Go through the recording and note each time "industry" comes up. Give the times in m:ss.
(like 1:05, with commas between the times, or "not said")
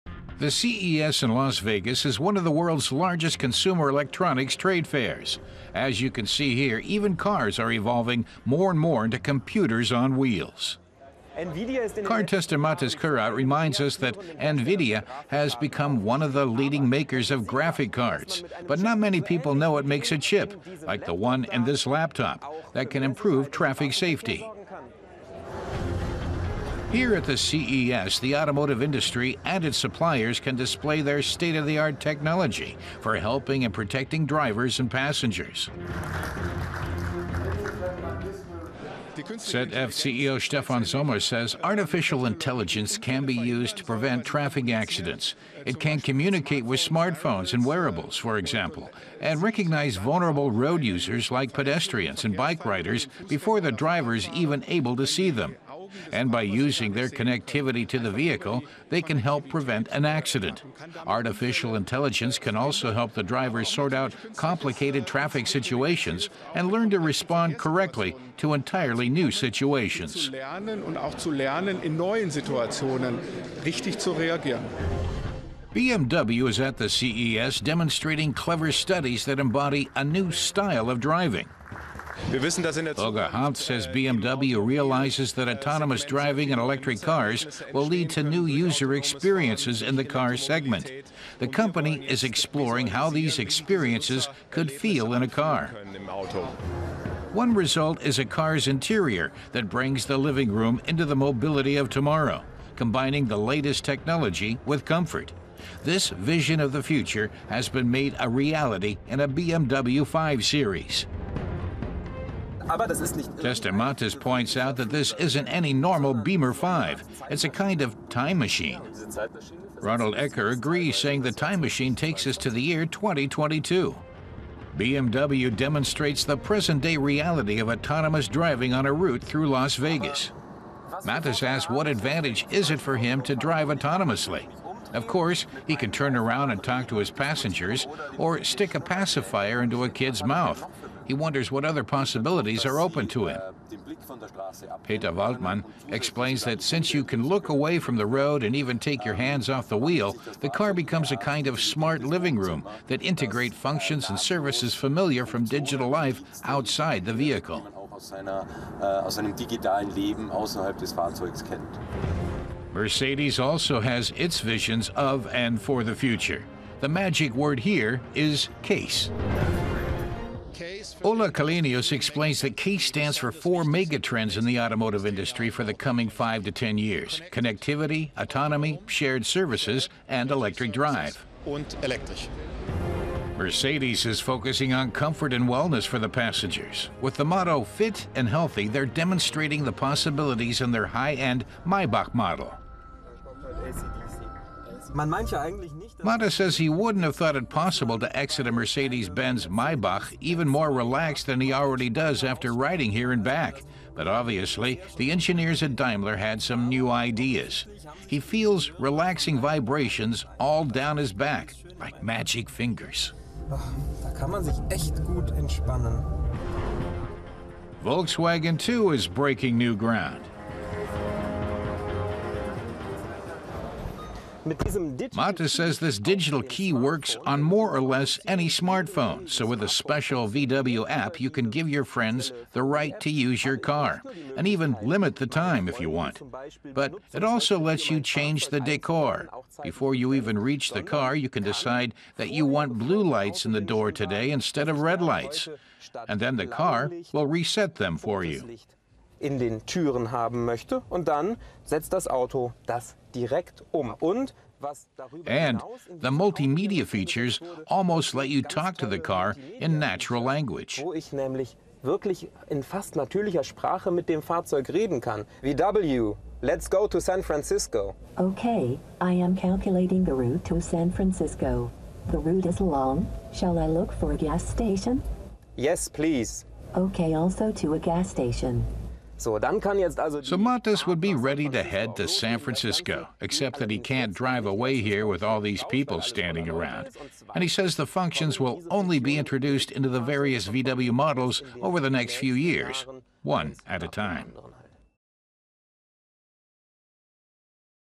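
0:28, 2:55.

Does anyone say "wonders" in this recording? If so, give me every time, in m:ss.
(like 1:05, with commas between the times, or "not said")
2:21.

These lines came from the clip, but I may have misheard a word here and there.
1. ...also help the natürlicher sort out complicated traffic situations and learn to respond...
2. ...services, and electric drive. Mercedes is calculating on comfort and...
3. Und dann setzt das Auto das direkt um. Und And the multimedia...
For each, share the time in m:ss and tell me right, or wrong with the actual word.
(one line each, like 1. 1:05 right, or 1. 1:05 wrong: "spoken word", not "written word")
1. 1:02 wrong: "driver", not "natürlicher"
2. 2:59 wrong: "focusing", not "calculating"
3. 4:10 right.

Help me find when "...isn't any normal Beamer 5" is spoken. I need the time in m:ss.
1:55.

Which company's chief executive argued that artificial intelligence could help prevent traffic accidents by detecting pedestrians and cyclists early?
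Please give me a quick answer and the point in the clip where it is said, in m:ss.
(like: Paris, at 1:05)
ZF, at 0:39.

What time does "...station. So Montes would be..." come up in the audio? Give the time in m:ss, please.
4:38.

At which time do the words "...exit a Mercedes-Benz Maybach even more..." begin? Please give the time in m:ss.
3:18.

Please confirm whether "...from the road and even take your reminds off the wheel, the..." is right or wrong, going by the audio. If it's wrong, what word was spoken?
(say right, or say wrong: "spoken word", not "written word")
wrong: "hands", not "reminds".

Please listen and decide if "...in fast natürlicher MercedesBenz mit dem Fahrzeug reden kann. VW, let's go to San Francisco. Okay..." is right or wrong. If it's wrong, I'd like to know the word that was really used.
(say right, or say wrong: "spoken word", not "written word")
wrong: "Sprache", not "MercedesBenz".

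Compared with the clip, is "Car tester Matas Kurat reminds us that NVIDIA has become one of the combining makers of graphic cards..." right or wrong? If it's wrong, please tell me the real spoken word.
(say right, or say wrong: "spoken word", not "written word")
wrong: "leading", not "combining".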